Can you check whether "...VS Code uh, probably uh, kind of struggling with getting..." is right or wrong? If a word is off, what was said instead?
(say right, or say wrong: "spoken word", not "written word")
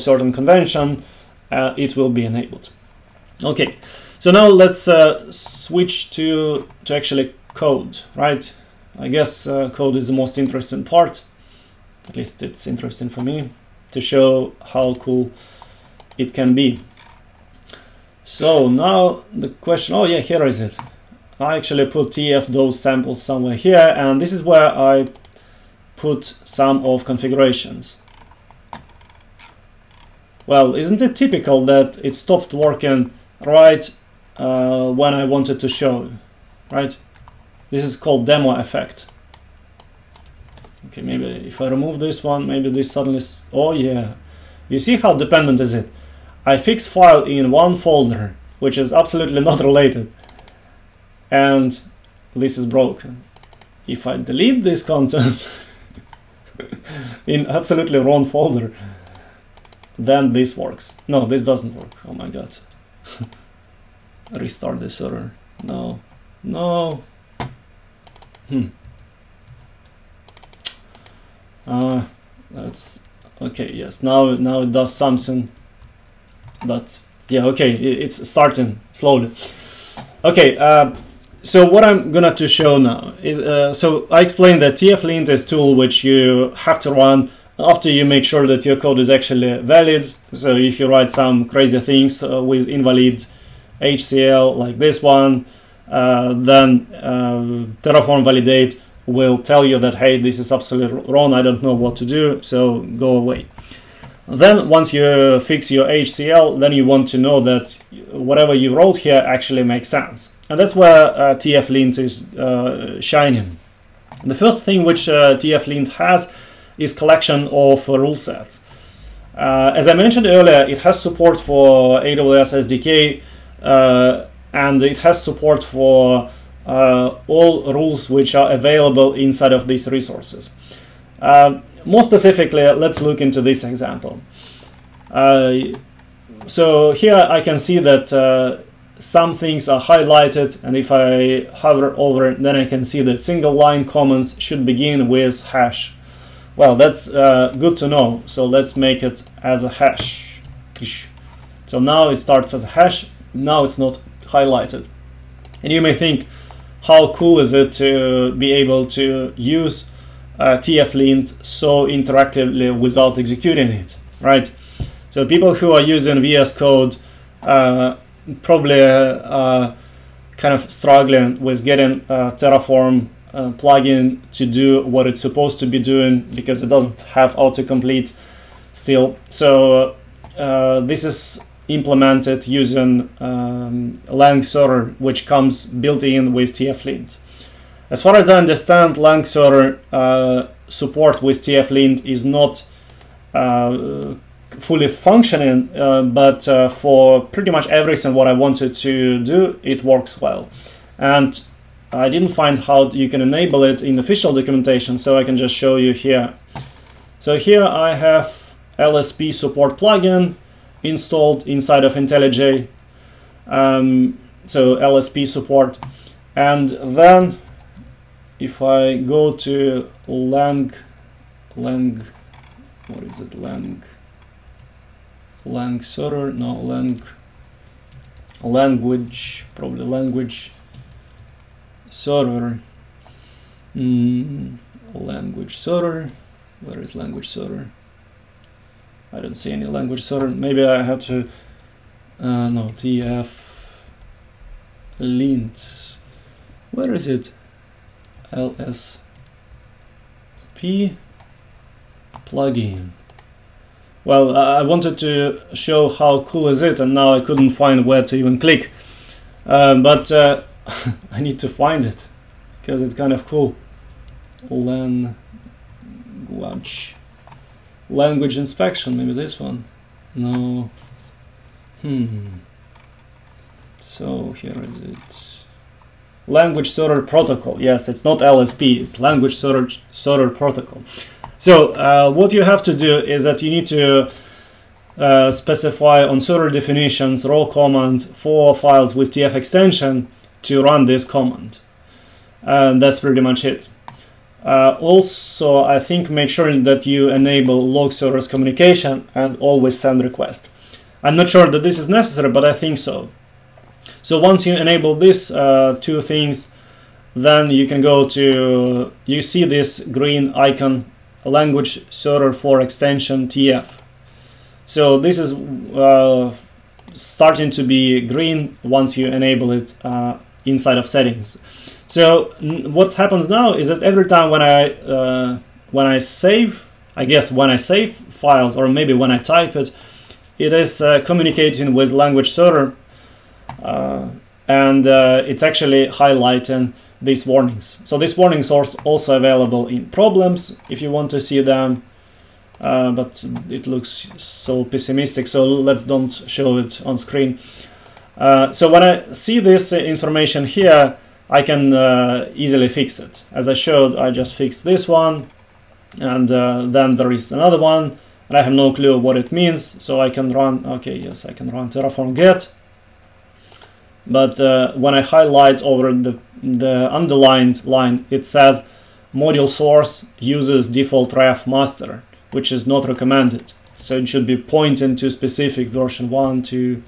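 right.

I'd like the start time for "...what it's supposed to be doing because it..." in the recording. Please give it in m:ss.
2:54.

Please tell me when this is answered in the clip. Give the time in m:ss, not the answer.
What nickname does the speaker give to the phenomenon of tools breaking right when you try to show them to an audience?
0:38.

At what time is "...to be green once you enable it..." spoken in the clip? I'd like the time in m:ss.
5:17.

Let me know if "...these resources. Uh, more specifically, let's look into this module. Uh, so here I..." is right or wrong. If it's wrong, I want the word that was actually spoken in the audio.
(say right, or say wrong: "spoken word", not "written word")
wrong: "example", not "module".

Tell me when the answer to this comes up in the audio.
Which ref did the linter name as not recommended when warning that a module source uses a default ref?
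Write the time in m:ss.
6:11.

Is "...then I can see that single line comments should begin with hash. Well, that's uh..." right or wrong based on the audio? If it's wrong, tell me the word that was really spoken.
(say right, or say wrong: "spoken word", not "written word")
right.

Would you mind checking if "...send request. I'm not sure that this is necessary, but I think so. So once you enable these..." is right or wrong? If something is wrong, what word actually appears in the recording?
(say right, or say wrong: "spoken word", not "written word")
right.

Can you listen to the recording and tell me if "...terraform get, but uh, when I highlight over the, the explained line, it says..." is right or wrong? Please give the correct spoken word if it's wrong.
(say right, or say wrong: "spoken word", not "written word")
wrong: "underlined", not "explained".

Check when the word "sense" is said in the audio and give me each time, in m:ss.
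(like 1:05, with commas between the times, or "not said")
1:49.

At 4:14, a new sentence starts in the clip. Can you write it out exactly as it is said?
Well, I wanted to show how cool is it and now I couldn't find where to even click.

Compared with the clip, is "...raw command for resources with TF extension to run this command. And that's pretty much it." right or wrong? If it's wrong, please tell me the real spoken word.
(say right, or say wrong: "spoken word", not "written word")
wrong: "files", not "resources".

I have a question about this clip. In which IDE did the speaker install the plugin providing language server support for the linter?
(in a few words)
IntelliJ.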